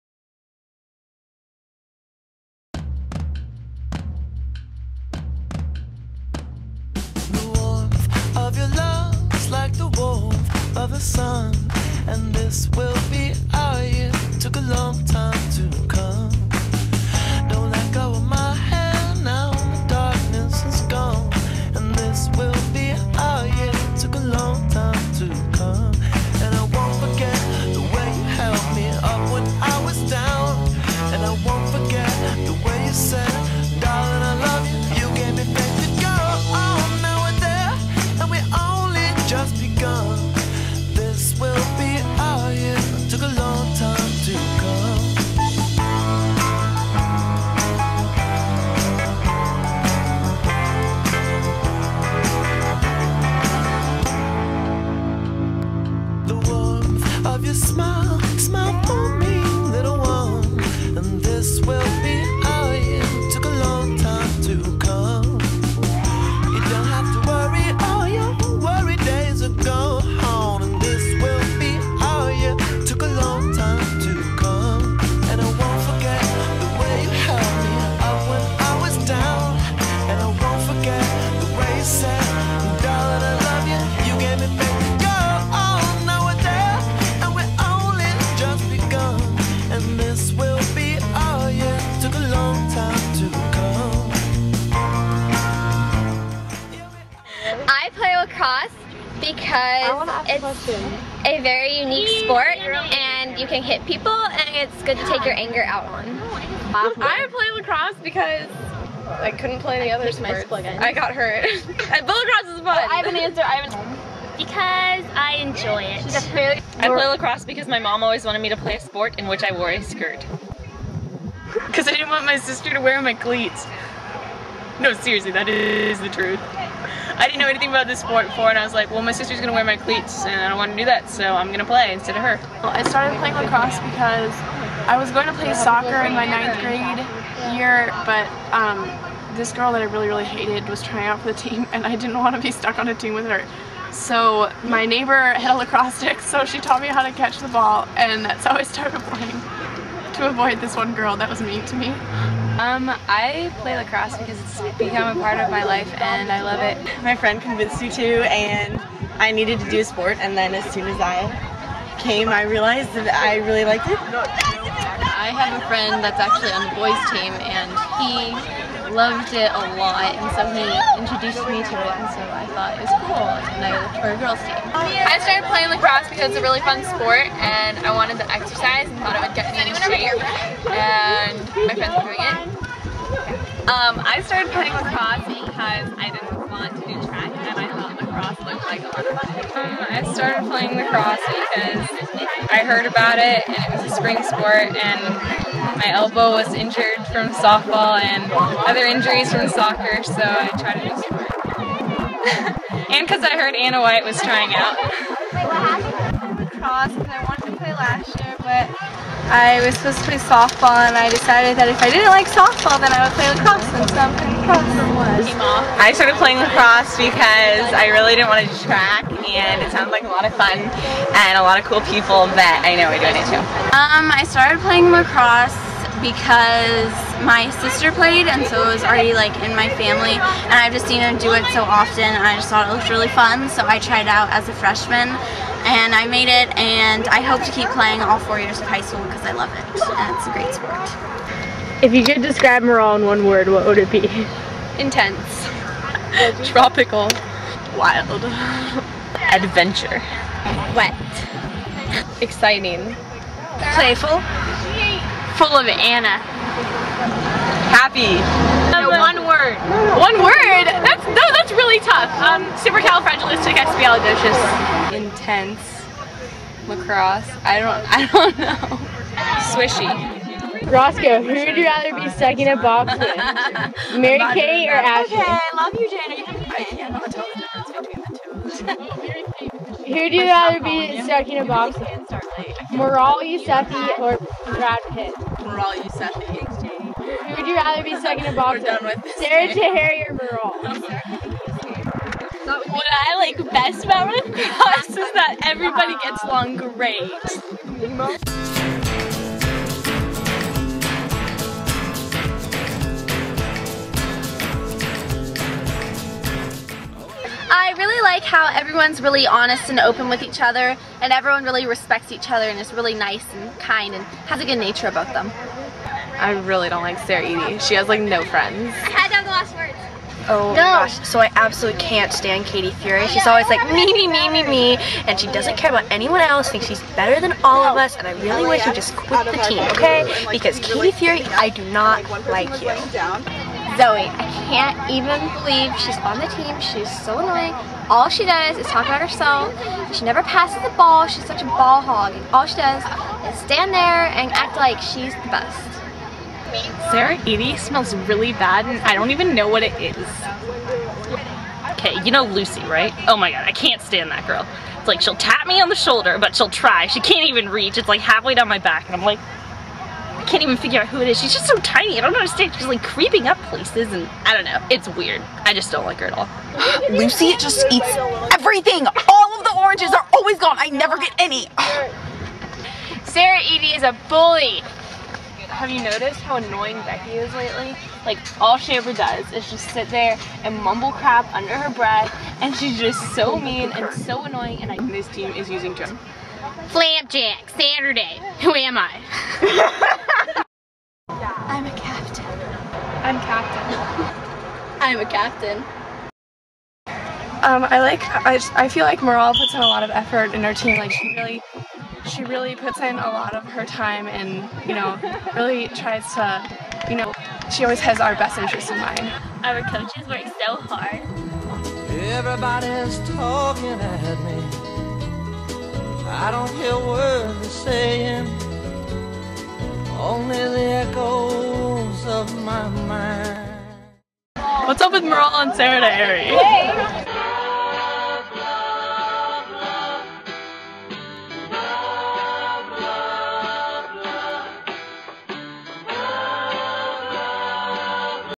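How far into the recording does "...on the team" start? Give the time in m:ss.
5:35.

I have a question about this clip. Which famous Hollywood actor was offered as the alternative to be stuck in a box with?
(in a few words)
Brad Pitt.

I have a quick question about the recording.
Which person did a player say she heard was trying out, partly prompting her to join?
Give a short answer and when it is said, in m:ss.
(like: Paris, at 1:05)
Anna White, at 3:23.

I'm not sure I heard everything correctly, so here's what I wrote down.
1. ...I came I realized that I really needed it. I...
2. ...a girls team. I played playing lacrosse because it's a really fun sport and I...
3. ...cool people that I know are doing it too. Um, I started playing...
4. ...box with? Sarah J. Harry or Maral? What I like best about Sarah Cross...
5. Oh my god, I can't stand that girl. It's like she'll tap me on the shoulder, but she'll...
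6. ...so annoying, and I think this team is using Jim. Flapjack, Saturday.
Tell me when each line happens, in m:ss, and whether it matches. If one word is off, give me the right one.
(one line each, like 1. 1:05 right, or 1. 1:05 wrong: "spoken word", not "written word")
1. 2:40 wrong: "liked", not "needed"
2. 2:54 wrong: "started", not "played"
3. 3:41 right
4. 4:48 wrong: "Red", not "Sarah"
5. 5:53 right
6. 6:23 right.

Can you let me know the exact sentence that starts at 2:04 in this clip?
No, seriously, that is the truth.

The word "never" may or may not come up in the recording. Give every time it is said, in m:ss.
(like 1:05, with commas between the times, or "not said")
5:40, 6:10.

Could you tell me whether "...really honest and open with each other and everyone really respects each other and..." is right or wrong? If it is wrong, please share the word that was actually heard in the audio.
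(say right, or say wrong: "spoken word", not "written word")
right.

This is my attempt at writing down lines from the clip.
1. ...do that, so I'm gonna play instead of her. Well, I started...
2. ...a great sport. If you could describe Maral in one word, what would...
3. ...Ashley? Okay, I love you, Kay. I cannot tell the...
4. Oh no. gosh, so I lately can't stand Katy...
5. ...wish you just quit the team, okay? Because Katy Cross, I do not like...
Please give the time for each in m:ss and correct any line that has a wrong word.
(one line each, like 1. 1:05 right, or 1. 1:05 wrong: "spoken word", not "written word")
1. 2:10 right
2. 4:00 right
3. 4:34 wrong: "Jane", not "Kay"
4. 5:20 wrong: "absolutely", not "lately"
5. 5:28 wrong: "Fury", not "Cross".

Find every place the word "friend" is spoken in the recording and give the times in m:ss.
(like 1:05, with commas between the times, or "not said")
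2:37, 2:45, 3:02, 5:18.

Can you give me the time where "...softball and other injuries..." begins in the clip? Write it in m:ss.
3:17.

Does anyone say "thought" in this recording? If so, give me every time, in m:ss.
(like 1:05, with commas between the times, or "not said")
2:52, 2:58, 3:07, 3:52.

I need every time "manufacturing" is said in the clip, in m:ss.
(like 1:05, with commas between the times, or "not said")
not said.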